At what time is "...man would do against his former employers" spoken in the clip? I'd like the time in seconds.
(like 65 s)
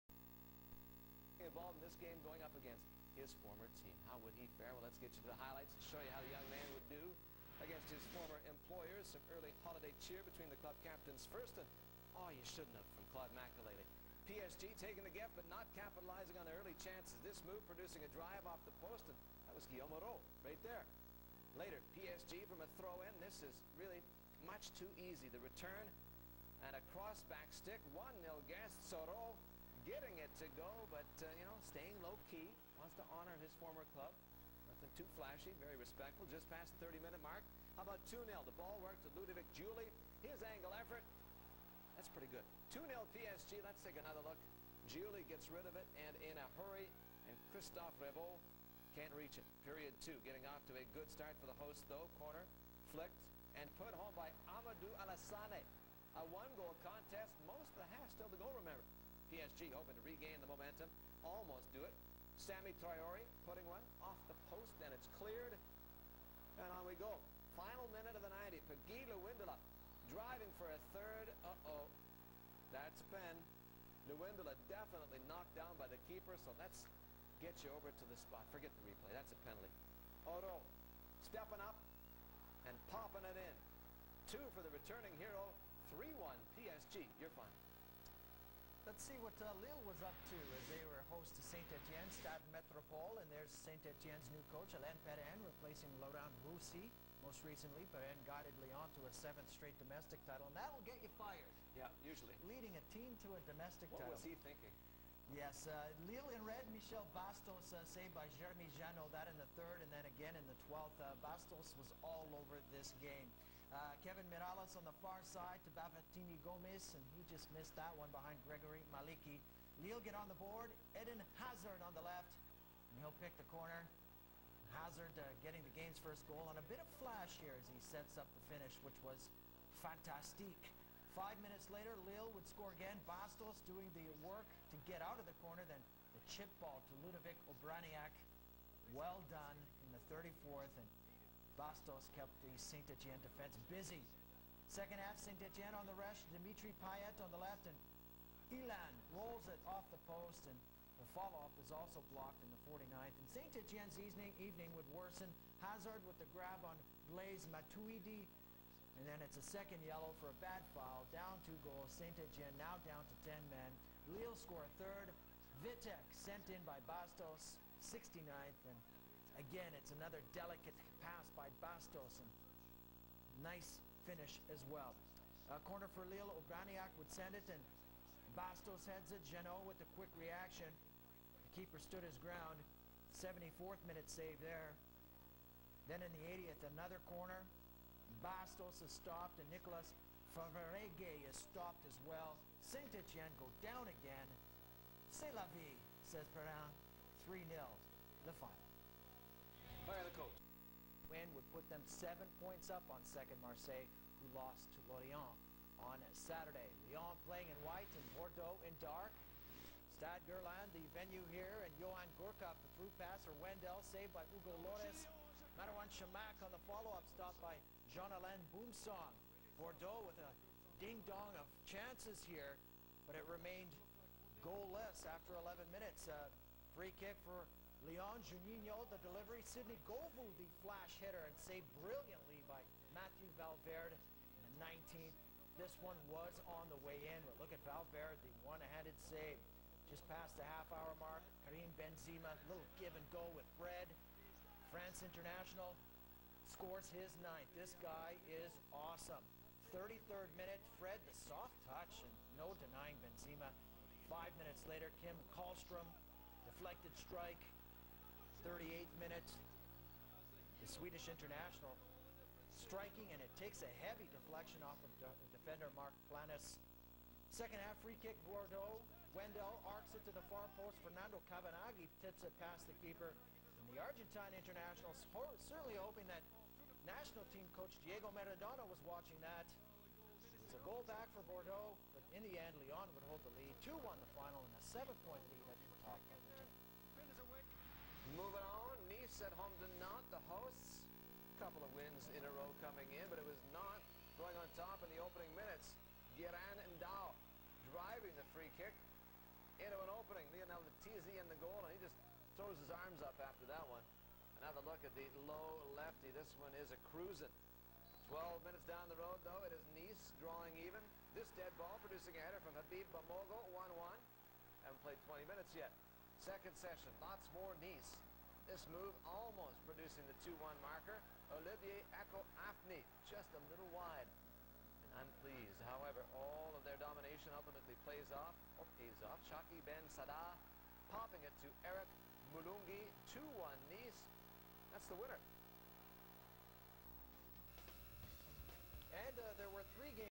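6 s.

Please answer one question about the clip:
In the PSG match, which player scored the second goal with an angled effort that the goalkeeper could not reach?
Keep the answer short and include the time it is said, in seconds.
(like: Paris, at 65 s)
Ludovic Giuly, at 39 s.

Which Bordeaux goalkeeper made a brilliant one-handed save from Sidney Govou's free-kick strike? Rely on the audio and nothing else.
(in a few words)
Mathieu Valverde.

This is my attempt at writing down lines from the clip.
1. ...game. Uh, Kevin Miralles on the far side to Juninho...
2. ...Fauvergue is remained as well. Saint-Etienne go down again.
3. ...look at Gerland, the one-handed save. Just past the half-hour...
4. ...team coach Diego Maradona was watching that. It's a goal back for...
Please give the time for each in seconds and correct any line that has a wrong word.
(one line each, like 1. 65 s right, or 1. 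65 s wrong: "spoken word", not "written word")
1. 112 s wrong: "Bafétimbi", not "Juninho"
2. 190 s wrong: "stopped", not "remained"
3. 237 s wrong: "Valverde", not "Gerland"
4. 277 s right.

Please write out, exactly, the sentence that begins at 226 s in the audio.
A free kick for Leon Juninho, the delivery.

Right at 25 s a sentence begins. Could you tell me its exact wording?
The return and a cross-back stick.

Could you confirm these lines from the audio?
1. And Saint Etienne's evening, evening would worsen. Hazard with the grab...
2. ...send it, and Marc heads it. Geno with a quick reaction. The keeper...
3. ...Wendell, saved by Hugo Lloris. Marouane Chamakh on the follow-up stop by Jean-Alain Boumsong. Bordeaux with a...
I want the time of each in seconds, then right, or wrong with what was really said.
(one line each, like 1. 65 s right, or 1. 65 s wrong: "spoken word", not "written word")
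1. 153 s right
2. 177 s wrong: "Bastos", not "Marc"
3. 213 s right.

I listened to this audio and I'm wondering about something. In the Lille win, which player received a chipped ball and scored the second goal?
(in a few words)
Ludovic Obraniak.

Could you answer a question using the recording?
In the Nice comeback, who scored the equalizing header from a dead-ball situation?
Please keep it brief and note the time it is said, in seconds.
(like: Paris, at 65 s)
Habib Bamogo, at 312 s.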